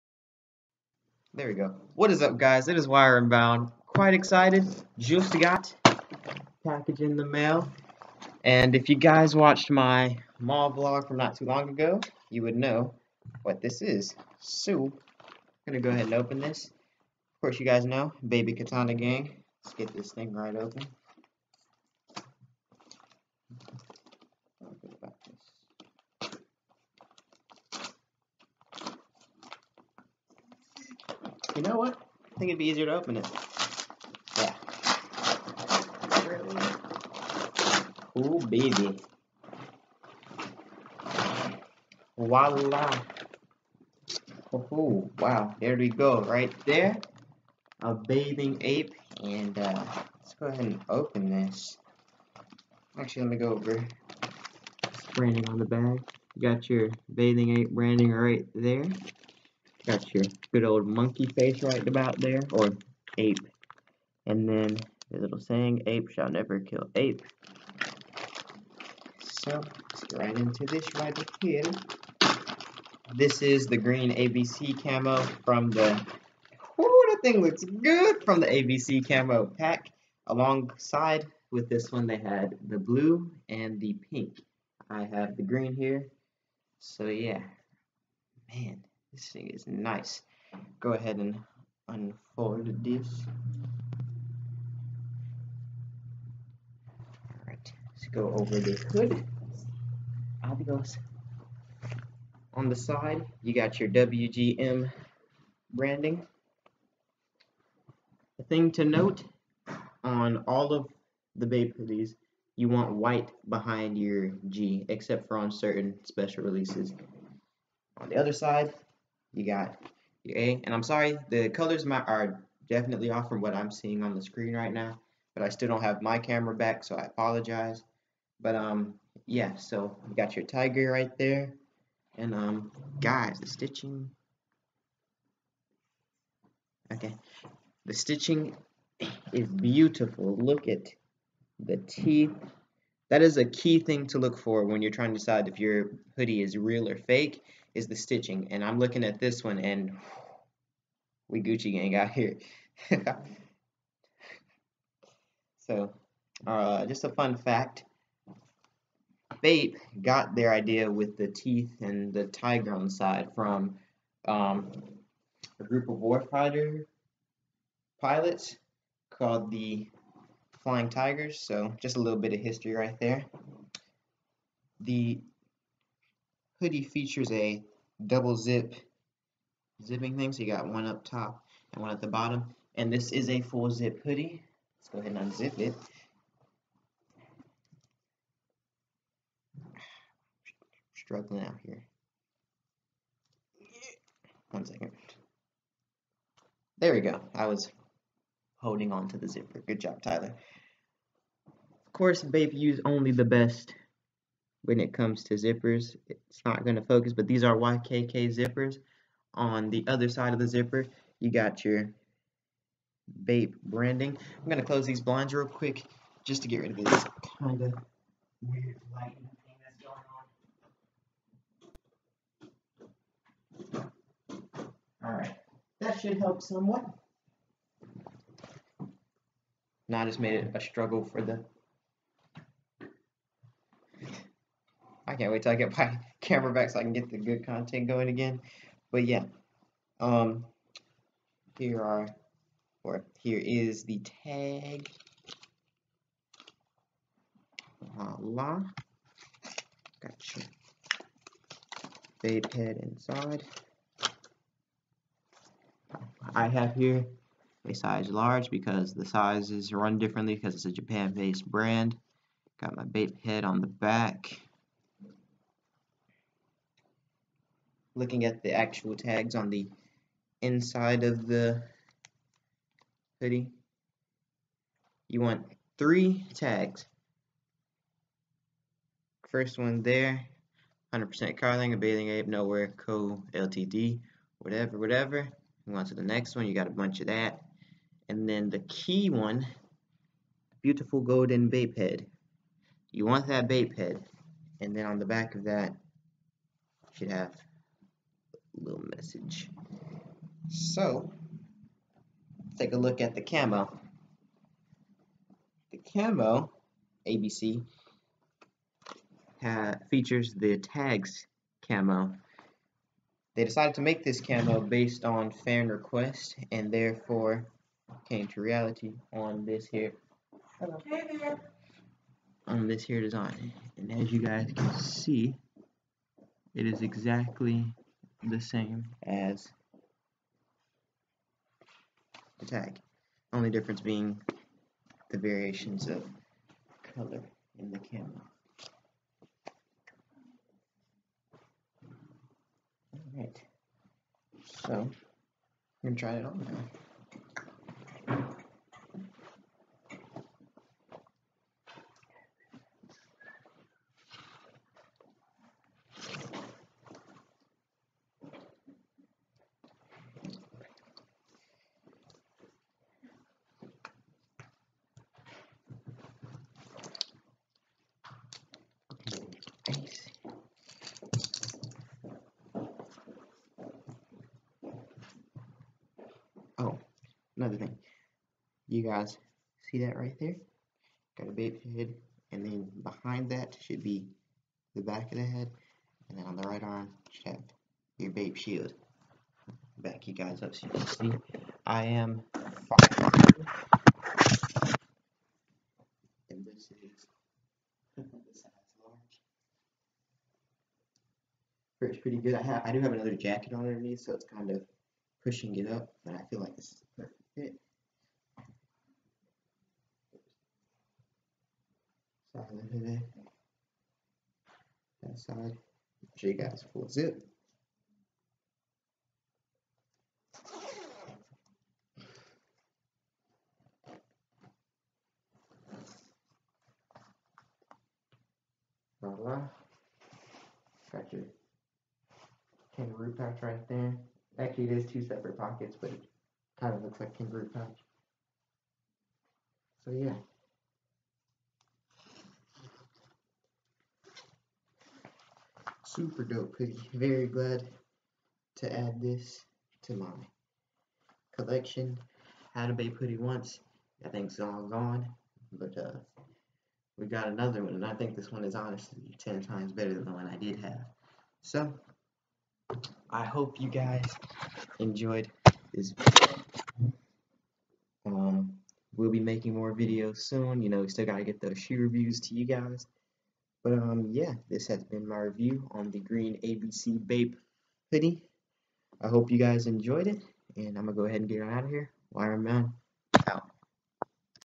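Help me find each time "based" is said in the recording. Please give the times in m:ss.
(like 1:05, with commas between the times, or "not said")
4:20, 5:14.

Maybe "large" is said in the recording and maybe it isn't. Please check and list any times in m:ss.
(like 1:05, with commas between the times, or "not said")
4:18, 6:37.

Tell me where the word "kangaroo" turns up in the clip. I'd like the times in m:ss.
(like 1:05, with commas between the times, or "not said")
7:12, 7:17.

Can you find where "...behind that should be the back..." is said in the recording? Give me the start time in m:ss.
6:22.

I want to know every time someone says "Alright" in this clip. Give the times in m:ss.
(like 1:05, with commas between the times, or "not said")
1:37, 3:45, 5:43.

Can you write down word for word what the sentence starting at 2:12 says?
And um, guys, the stitching, okay, the stitching is beautiful.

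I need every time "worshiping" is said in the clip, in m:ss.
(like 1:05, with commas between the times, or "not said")
not said.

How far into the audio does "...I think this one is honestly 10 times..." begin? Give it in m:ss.
7:37.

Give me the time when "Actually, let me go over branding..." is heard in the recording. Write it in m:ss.
0:52.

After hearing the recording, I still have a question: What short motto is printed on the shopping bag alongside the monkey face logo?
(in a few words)
Ape shall never kill ape.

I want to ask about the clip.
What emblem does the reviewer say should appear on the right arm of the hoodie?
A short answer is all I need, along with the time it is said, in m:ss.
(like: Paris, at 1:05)
Bape shield, at 6:28.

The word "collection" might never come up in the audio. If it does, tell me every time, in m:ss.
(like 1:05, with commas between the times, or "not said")
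7:31.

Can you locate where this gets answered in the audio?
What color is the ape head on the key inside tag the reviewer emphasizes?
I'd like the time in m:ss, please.
4:50.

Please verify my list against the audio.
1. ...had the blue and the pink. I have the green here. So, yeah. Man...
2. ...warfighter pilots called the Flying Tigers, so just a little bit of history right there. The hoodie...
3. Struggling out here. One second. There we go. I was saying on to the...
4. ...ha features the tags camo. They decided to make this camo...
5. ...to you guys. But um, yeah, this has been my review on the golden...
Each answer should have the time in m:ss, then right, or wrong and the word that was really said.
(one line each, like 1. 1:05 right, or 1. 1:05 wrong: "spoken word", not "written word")
1. 1:22 right
2. 2:45 right
3. 3:10 wrong: "holding", not "saying"
4. 5:09 right
5. 7:52 wrong: "green", not "golden".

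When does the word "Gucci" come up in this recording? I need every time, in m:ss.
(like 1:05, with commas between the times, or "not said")
2:31.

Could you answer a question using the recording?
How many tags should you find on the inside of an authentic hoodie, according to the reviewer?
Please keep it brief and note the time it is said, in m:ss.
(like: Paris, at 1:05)
3, at 4:35.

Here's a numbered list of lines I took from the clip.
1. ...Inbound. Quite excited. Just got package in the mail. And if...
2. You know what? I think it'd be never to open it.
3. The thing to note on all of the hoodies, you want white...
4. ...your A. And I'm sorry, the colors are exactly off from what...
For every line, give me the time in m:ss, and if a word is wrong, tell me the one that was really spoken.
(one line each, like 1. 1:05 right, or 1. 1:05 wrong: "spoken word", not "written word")
1. 0:03 right
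2. 0:31 wrong: "easier", not "never"
3. 1:48 right
4. 2:00 wrong: "definitely", not "exactly".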